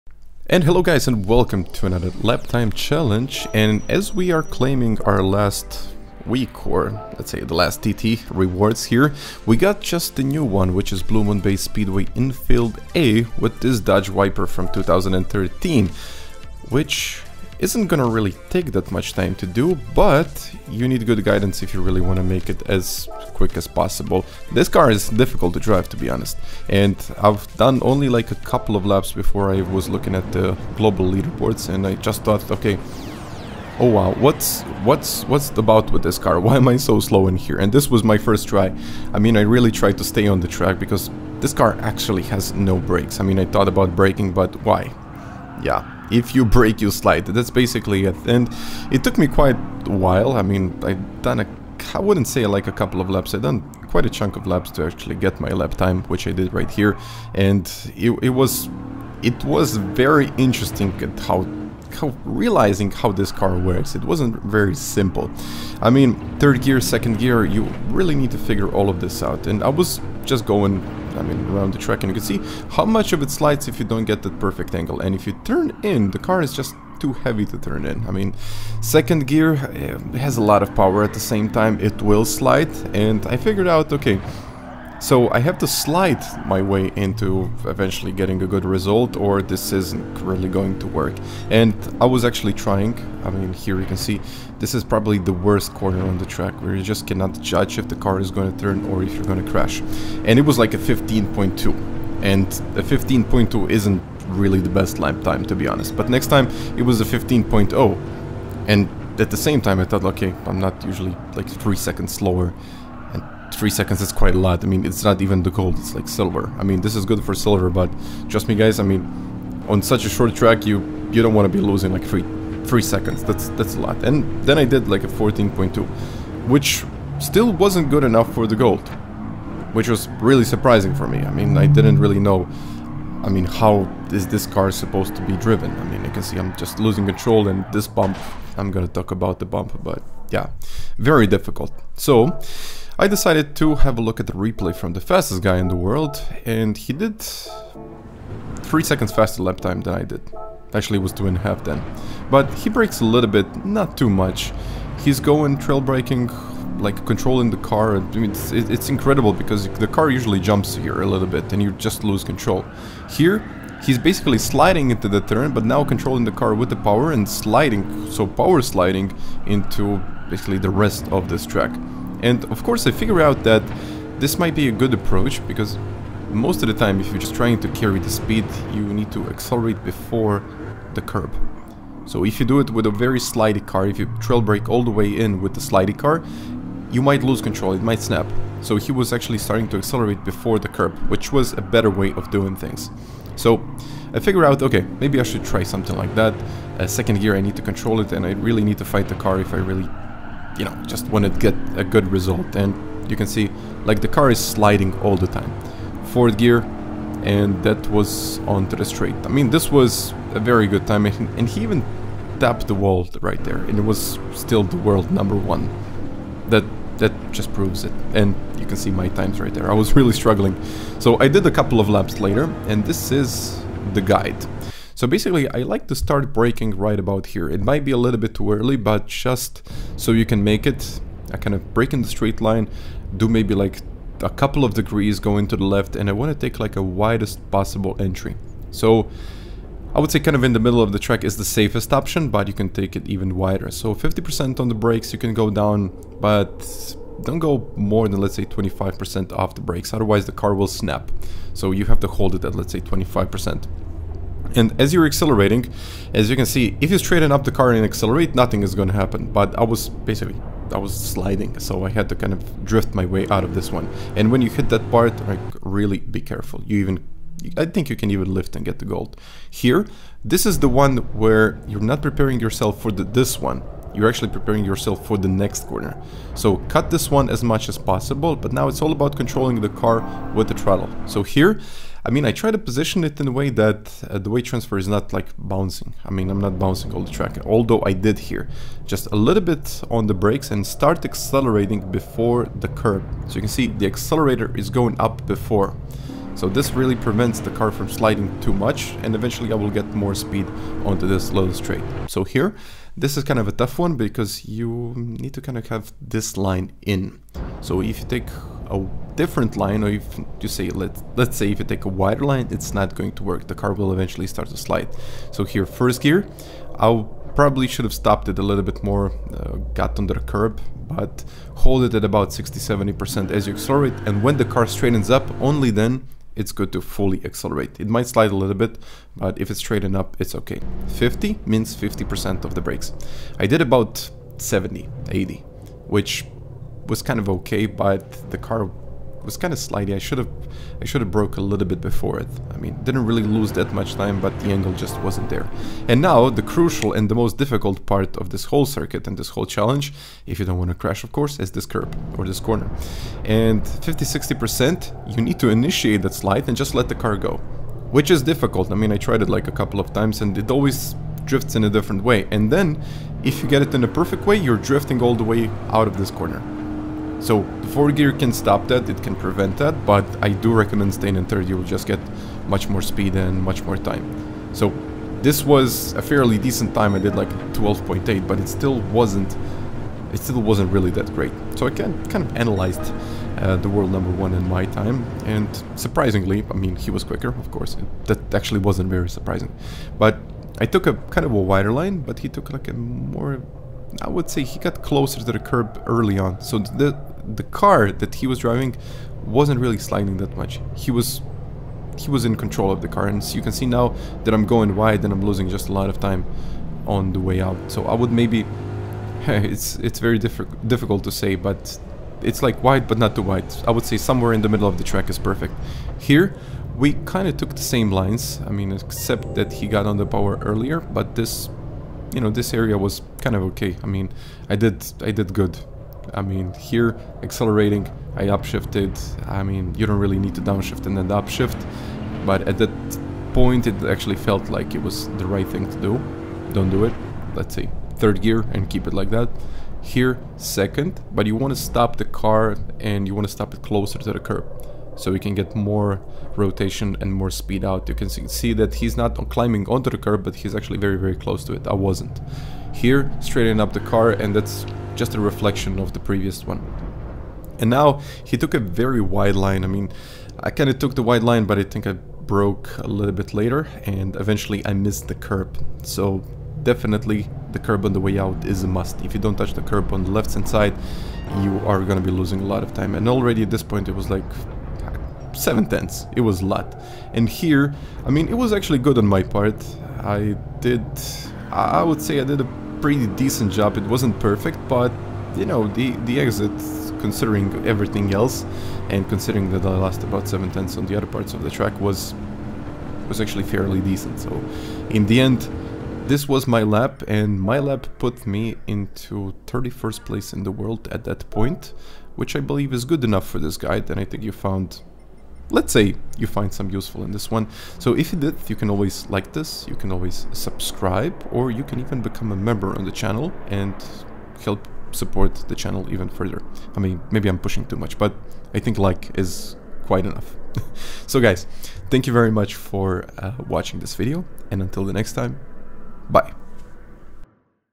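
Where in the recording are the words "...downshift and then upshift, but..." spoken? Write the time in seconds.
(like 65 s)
430 s.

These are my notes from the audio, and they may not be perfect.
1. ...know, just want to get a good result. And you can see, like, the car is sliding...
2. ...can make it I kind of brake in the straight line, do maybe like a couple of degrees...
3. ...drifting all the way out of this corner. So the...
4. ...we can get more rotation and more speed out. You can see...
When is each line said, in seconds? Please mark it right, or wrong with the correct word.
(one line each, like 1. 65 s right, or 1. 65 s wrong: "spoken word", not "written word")
1. 200 s right
2. 230 s right
3. 364 s right
4. 445 s right.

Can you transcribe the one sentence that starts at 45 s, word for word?
Yeah, if you brake you slide.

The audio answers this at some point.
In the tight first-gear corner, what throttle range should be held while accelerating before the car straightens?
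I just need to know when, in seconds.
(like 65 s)
322 s.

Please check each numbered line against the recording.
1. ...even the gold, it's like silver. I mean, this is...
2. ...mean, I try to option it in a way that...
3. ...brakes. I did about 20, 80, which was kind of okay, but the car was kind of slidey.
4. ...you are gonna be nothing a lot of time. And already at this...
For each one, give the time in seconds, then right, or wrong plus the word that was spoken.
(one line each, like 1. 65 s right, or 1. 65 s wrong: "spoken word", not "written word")
1. 115 s right
2. 282 s wrong: "position", not "option"
3. 332 s wrong: "70", not "20"
4. 471 s wrong: "losing", not "nothing".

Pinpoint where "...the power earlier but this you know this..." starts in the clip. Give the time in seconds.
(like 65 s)
419 s.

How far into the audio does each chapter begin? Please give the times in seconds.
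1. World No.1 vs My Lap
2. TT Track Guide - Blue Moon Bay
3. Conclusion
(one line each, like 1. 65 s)
1. 383 s
2. 220 s
3. 495 s.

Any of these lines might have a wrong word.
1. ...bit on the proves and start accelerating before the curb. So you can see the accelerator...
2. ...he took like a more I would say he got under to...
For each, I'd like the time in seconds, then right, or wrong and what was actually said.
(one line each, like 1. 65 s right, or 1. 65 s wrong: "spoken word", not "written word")
1. 289 s wrong: "brakes", not "proves"
2. 392 s wrong: "closer", not "under".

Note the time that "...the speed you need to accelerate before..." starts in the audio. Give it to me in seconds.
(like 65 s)
177 s.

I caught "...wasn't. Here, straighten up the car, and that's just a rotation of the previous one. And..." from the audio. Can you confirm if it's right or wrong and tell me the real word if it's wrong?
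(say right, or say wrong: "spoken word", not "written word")
wrong: "reflection", not "rotation".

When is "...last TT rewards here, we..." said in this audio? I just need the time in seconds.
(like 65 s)
7 s.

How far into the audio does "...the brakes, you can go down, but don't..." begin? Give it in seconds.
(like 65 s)
244 s.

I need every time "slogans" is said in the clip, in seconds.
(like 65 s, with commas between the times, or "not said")
not said.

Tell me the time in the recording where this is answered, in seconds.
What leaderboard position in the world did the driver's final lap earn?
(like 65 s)
499 s.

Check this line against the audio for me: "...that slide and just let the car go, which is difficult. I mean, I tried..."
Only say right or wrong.
right.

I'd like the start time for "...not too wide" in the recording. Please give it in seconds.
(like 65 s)
412 s.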